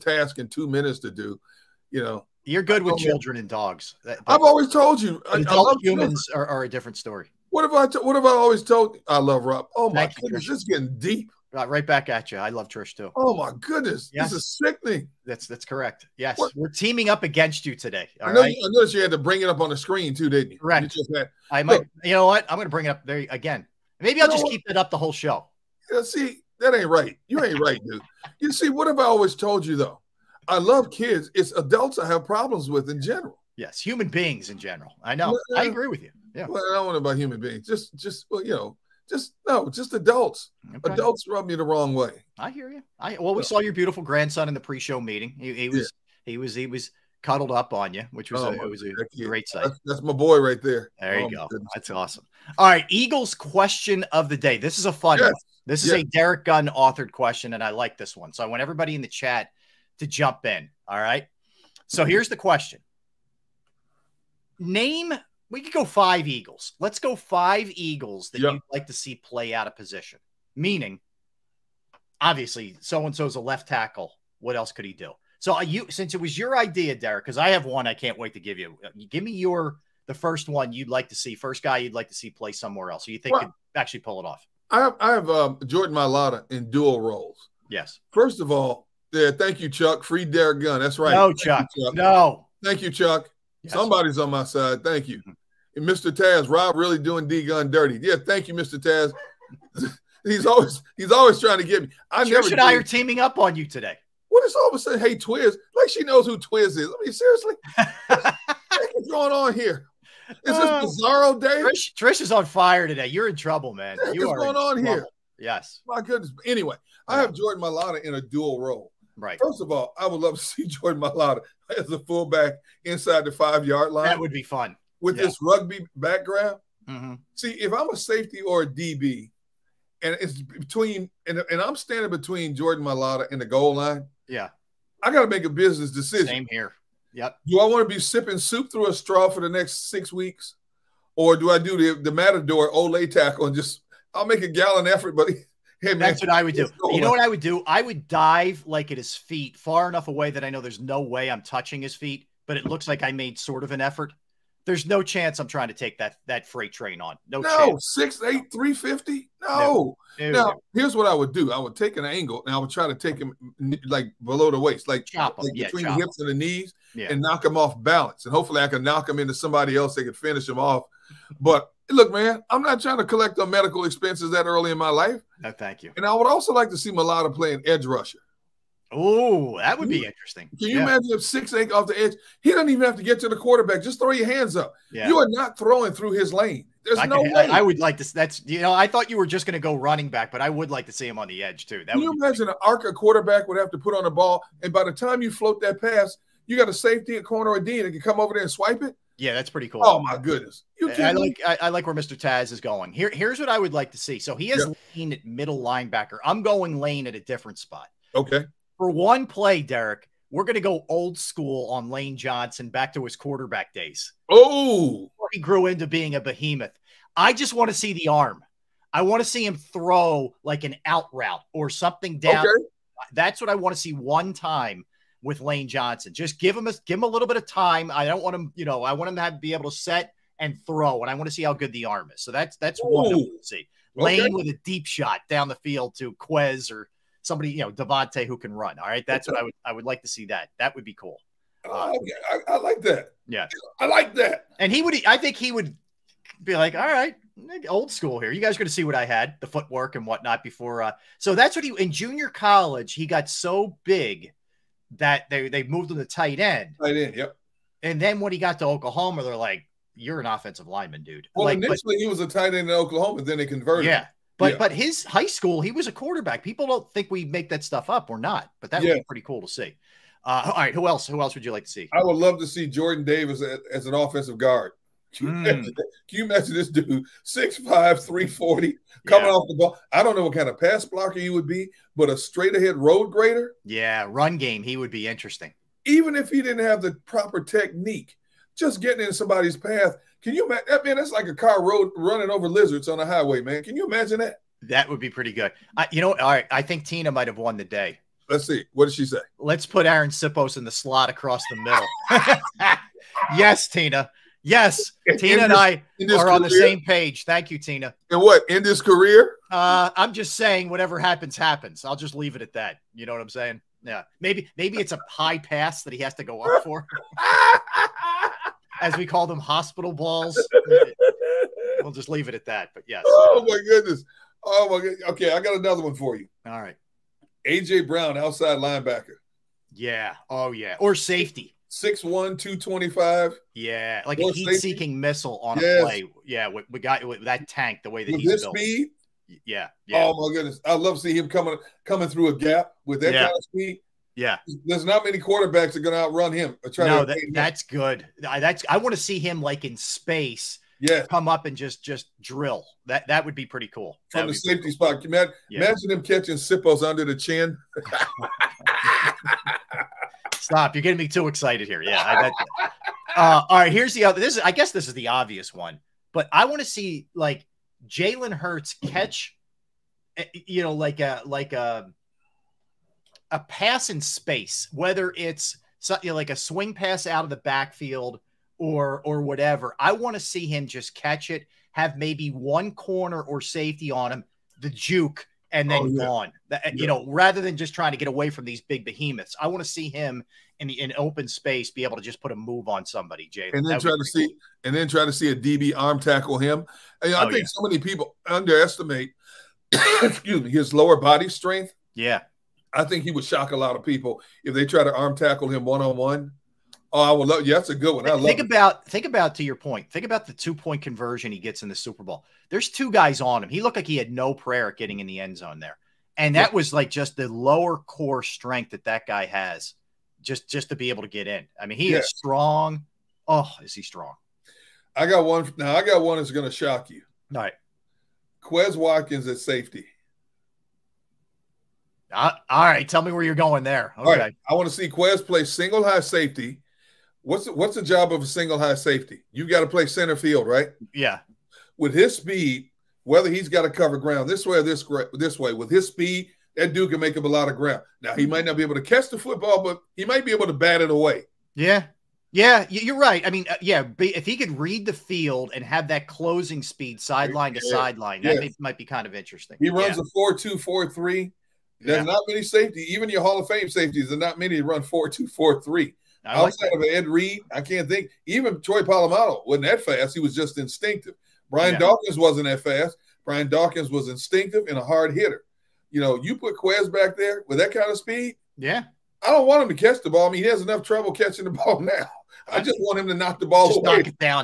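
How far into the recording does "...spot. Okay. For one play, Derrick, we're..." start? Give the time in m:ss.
3:27.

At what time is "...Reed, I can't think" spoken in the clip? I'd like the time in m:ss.
7:47.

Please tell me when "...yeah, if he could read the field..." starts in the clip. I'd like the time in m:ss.
7:33.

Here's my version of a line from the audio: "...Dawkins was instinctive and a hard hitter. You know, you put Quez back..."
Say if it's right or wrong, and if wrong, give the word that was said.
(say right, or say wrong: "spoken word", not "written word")
right.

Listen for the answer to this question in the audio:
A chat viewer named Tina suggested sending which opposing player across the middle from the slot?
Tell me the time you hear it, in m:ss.
4:59.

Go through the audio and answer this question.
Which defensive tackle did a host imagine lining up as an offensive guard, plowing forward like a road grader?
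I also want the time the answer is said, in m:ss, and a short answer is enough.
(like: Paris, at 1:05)
Jordan Davis, at 4:32.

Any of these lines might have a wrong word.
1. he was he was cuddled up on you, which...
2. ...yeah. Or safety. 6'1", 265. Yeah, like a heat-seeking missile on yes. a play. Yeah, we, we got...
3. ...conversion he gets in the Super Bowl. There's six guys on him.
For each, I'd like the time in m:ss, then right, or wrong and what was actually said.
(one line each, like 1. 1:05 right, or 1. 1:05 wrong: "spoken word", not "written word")
1. 0:46 right
2. 5:30 wrong: "225", not "265"
3. 6:50 wrong: "two", not "six".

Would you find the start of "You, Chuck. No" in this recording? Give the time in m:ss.
1:31.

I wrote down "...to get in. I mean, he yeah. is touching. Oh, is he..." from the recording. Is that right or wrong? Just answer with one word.
wrong.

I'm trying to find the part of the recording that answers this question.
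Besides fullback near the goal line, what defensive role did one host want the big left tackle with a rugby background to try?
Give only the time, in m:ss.
2:57.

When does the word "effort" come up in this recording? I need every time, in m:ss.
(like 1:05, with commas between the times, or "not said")
2:24, 2:33.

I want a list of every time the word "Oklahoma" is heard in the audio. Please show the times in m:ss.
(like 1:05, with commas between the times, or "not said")
4:18, 4:22.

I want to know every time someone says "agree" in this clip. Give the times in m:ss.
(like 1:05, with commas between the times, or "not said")
0:35.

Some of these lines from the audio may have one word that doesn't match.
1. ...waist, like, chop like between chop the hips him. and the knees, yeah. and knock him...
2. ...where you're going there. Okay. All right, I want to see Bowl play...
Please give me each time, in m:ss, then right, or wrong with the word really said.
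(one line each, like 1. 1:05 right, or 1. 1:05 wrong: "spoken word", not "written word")
1. 2:44 right
2. 7:13 wrong: "Quez", not "Bowl".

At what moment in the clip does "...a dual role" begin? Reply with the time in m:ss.
1:58.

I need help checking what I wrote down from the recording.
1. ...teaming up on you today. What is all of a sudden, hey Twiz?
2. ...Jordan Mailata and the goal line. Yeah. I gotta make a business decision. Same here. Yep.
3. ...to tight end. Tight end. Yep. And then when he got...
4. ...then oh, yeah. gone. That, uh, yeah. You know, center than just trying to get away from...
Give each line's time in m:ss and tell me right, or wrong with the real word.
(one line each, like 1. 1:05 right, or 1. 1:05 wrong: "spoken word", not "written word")
1. 1:42 right
2. 2:12 right
3. 4:15 right
4. 6:25 wrong: "rather", not "center".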